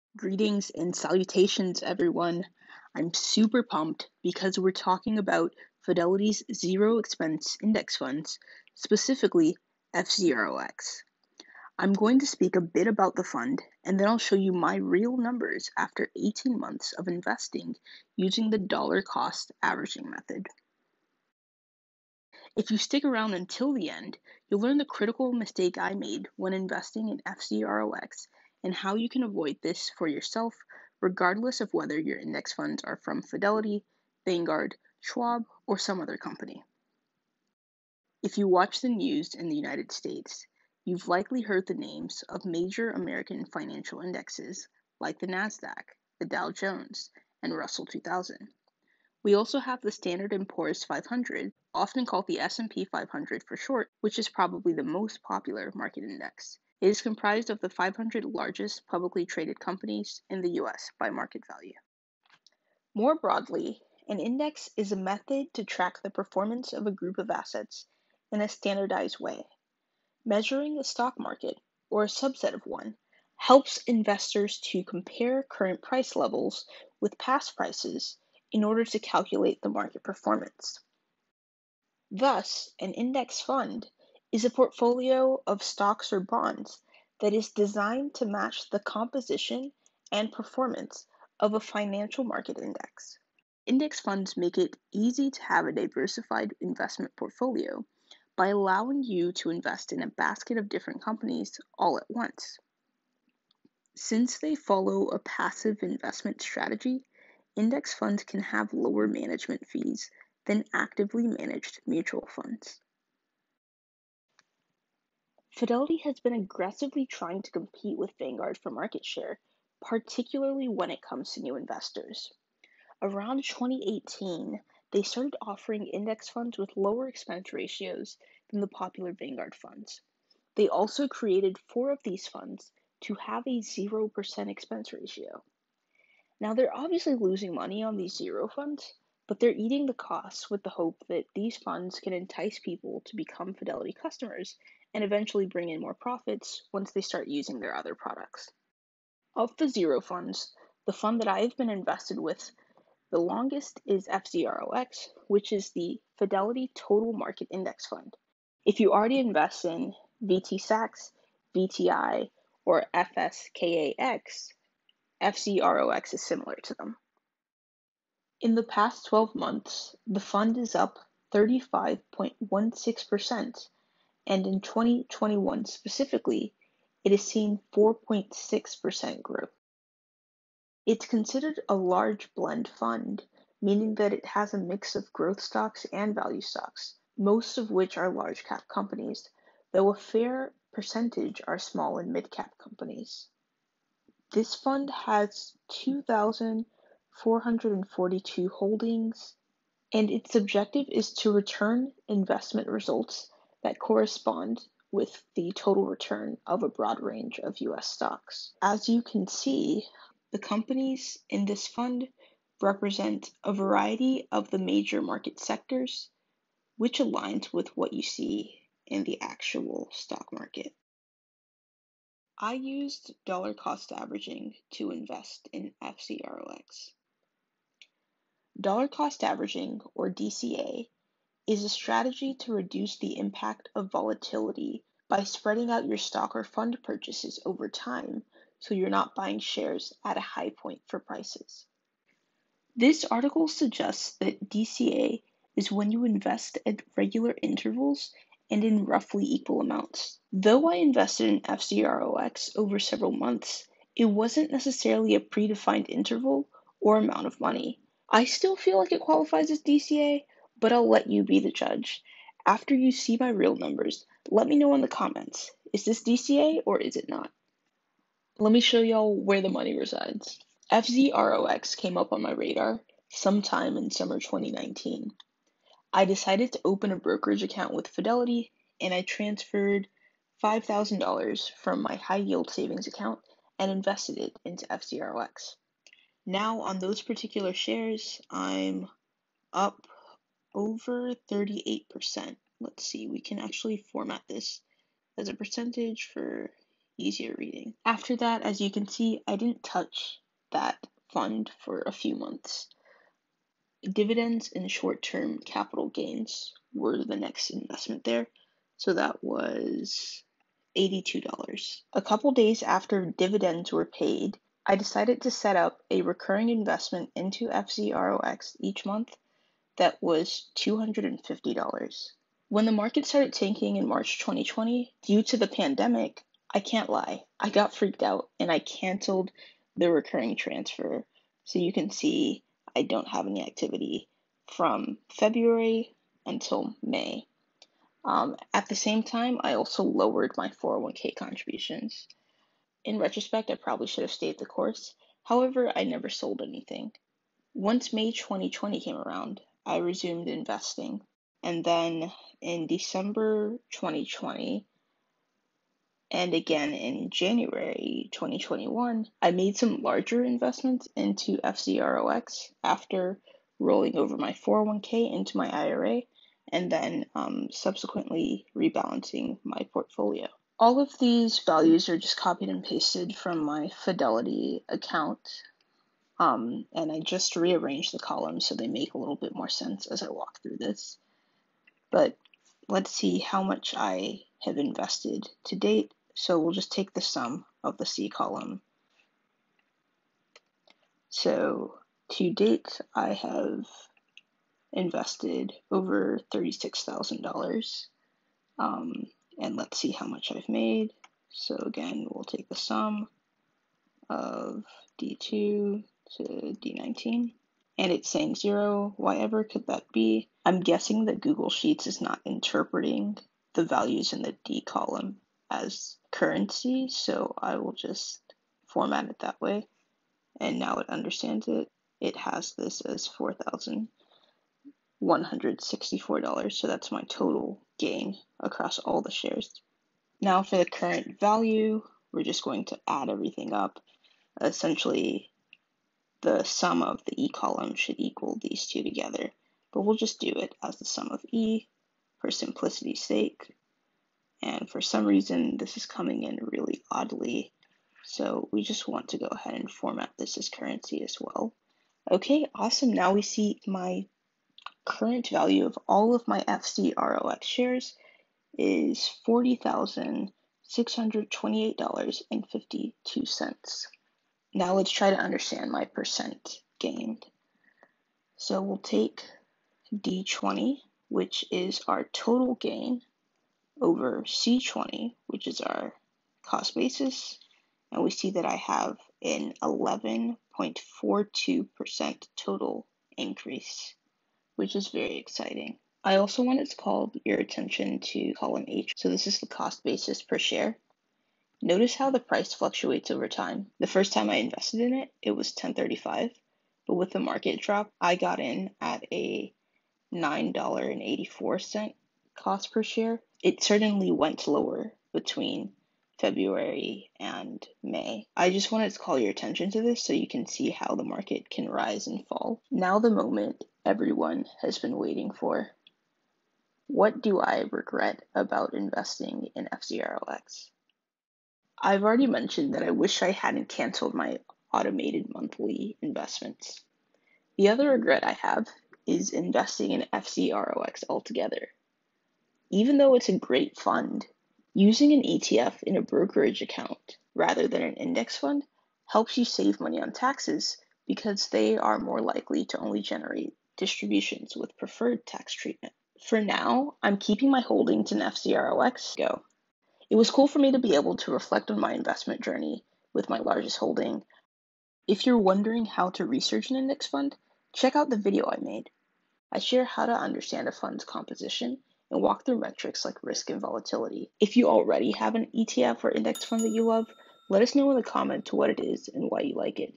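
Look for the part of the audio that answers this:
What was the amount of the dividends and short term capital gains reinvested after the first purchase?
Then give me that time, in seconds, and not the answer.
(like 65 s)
310 s.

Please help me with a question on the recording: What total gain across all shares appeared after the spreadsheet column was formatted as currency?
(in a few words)
$4,164.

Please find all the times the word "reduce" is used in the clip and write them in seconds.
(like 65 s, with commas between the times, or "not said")
232 s.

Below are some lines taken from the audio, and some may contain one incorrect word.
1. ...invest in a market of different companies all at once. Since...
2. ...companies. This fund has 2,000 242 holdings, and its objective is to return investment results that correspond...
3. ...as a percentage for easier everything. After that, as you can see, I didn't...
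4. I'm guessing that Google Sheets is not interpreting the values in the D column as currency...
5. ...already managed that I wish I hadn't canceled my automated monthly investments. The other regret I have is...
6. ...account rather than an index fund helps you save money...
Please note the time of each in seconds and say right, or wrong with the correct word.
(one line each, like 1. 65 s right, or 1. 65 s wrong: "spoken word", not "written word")
1. 99 s wrong: "basket", not "market"
2. 192 s wrong: "442", not "242"
3. 295 s wrong: "reading", not "everything"
4. 410 s right
5. 522 s wrong: "mentioned", not "managed"
6. 536 s right.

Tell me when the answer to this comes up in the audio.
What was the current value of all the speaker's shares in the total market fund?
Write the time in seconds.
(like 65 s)
459 s.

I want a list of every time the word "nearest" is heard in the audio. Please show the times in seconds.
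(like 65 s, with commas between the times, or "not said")
not said.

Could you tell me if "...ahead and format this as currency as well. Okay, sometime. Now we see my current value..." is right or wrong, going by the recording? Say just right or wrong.
wrong.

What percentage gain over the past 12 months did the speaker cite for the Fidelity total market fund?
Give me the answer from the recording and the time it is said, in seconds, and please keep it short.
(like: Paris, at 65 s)
35.16%, at 171 s.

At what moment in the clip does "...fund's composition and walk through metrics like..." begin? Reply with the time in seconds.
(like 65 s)
560 s.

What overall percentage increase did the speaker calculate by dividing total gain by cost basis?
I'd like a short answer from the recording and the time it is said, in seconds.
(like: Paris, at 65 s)
11.42%, at 479 s.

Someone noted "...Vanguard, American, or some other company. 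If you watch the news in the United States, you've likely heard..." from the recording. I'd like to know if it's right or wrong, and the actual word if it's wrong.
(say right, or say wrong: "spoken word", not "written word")
wrong: "Schwab", not "American".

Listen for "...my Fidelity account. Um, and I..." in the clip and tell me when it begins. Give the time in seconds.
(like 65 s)
373 s.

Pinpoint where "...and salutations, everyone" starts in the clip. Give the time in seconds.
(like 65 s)
0 s.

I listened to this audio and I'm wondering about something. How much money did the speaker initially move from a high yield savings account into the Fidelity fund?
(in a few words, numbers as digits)
$5,000.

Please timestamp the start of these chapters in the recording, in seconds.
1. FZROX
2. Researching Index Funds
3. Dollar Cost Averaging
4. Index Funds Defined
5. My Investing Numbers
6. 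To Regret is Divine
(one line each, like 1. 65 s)
1. 114 s
2. 546 s
3. 227 s
4. 38 s
5. 267 s
6. 521 s.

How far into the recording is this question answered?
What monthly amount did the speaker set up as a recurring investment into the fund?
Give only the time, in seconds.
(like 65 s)
320 s.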